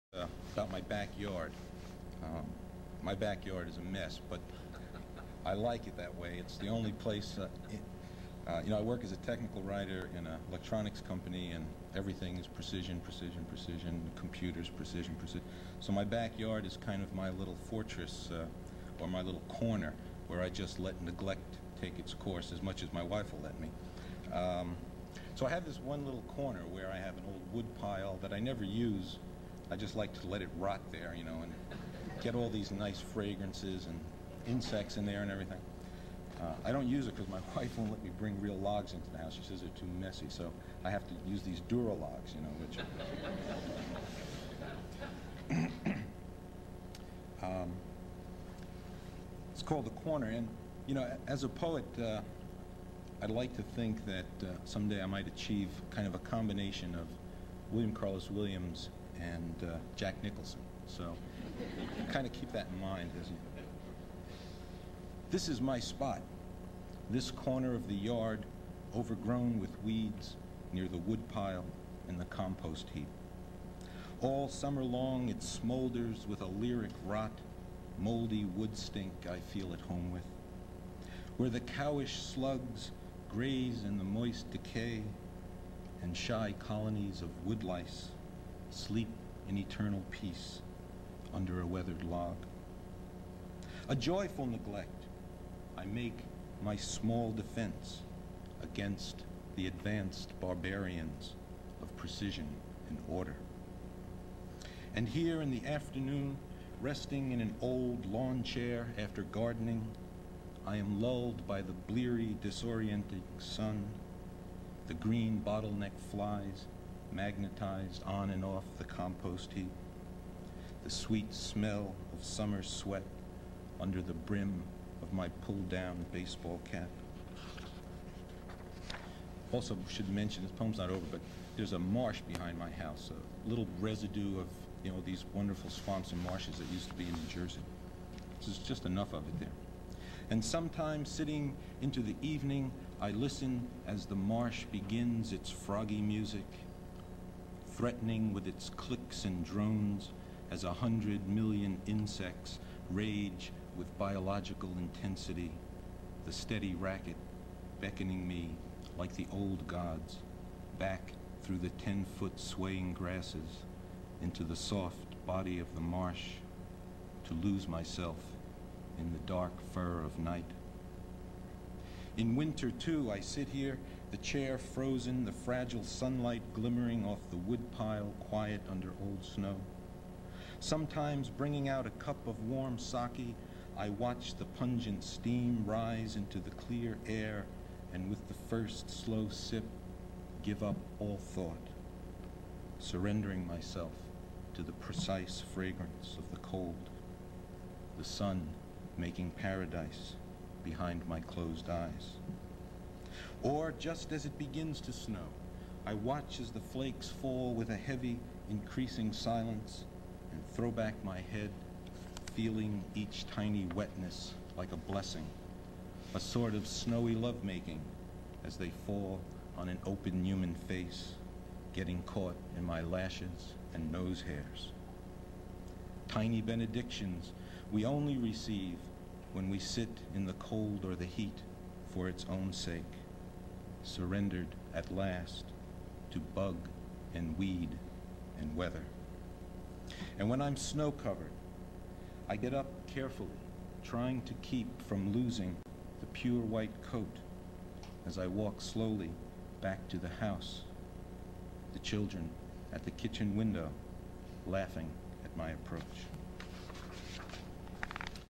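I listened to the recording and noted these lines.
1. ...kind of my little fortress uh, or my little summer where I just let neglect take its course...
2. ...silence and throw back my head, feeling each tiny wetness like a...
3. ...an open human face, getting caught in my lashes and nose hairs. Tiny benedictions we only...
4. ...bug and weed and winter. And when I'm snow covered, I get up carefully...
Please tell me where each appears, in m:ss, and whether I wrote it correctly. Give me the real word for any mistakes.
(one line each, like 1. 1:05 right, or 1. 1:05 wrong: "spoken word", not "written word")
1. 0:16 wrong: "corner", not "summer"
2. 3:29 right
3. 3:39 right
4. 3:56 wrong: "weather", not "winter".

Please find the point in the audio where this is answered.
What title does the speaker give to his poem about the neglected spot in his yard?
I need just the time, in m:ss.
0:49.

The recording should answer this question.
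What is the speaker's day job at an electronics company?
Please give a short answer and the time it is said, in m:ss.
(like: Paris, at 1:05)
Technical writer, at 0:09.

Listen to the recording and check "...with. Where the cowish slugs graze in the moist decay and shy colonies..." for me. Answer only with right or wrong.
right.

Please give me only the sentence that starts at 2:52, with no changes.
In winter, too, I sit here, the chair frozen, the fragile sunlight glimmering off the woodpile, quiet under old snow.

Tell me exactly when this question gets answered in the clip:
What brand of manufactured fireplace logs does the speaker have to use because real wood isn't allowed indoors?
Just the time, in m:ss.
0:41.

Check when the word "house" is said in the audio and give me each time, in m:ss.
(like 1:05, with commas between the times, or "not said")
0:39, 2:12, 4:10.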